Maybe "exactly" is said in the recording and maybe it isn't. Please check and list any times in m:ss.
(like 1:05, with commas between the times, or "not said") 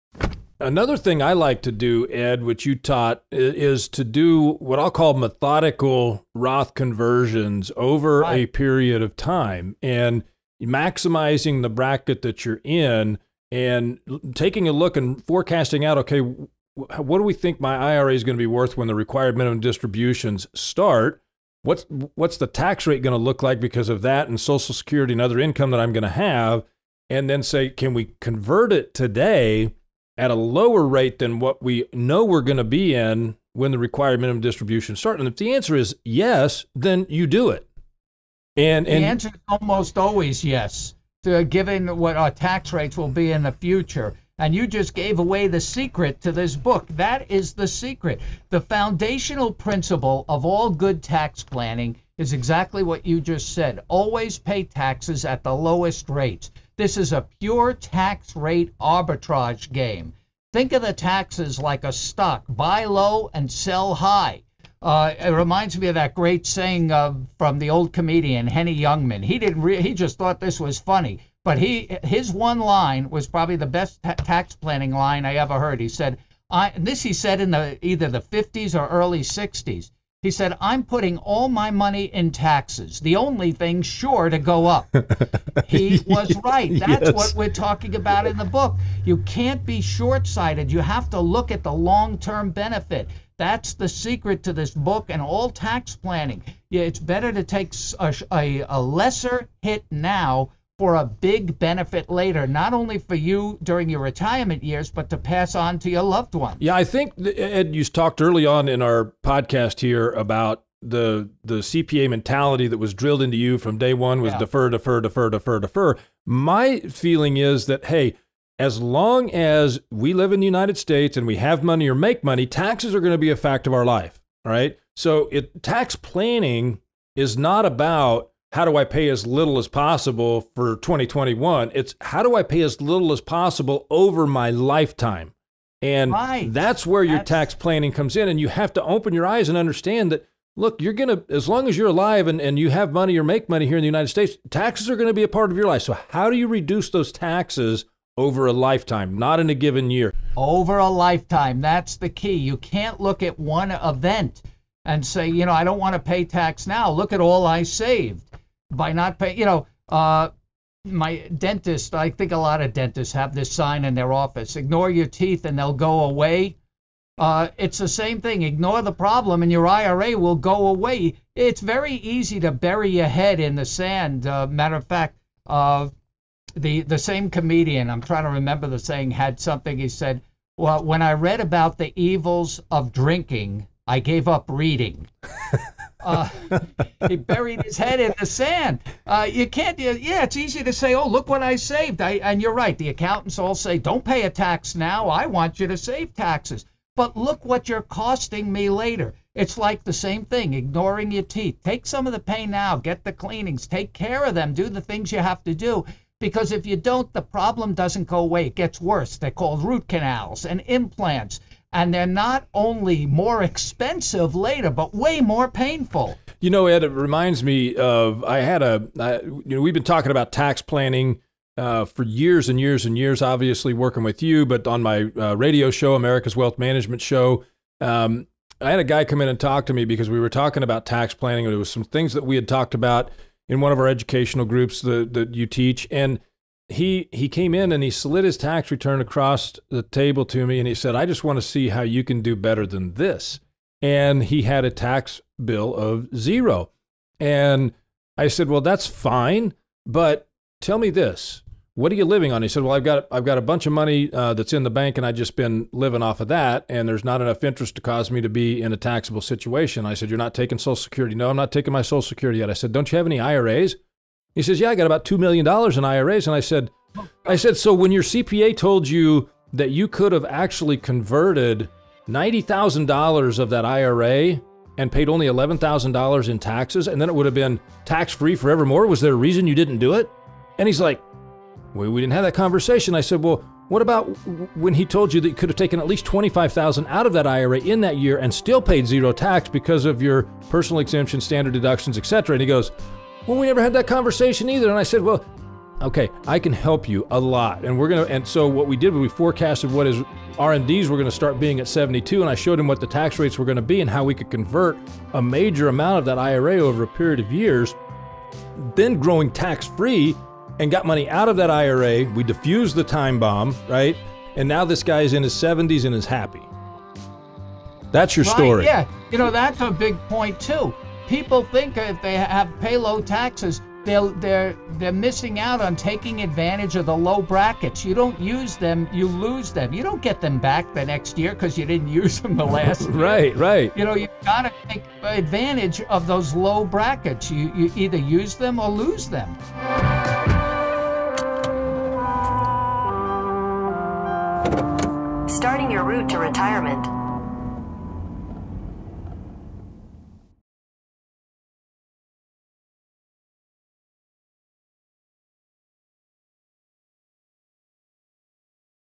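0:52.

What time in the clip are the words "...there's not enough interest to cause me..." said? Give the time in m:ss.
4:16.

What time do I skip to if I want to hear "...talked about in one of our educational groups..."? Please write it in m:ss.
3:52.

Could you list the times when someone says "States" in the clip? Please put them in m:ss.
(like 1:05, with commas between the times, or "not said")
2:00, 2:24.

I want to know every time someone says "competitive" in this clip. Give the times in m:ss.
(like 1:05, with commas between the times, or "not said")
not said.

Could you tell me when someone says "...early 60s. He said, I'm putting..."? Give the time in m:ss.
1:18.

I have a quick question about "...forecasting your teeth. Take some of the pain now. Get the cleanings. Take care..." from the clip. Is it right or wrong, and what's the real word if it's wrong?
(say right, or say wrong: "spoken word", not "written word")
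wrong: "ignoring", not "forecasting".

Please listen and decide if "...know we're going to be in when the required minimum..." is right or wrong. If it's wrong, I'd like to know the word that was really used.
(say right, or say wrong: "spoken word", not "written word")
right.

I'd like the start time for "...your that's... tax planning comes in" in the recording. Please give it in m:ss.
2:17.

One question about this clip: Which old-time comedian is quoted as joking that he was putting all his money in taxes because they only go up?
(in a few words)
Henny Youngman.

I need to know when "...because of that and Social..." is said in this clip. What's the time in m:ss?
0:23.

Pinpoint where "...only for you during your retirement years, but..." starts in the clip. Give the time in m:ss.
1:42.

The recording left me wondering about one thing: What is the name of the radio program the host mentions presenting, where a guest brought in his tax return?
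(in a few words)
America's Wealth Management Show.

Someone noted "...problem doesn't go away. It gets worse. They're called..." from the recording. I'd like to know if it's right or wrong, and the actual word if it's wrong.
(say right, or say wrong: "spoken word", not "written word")
right.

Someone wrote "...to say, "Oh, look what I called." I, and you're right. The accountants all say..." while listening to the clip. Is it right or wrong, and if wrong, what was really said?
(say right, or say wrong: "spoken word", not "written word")
wrong: "saved", not "called".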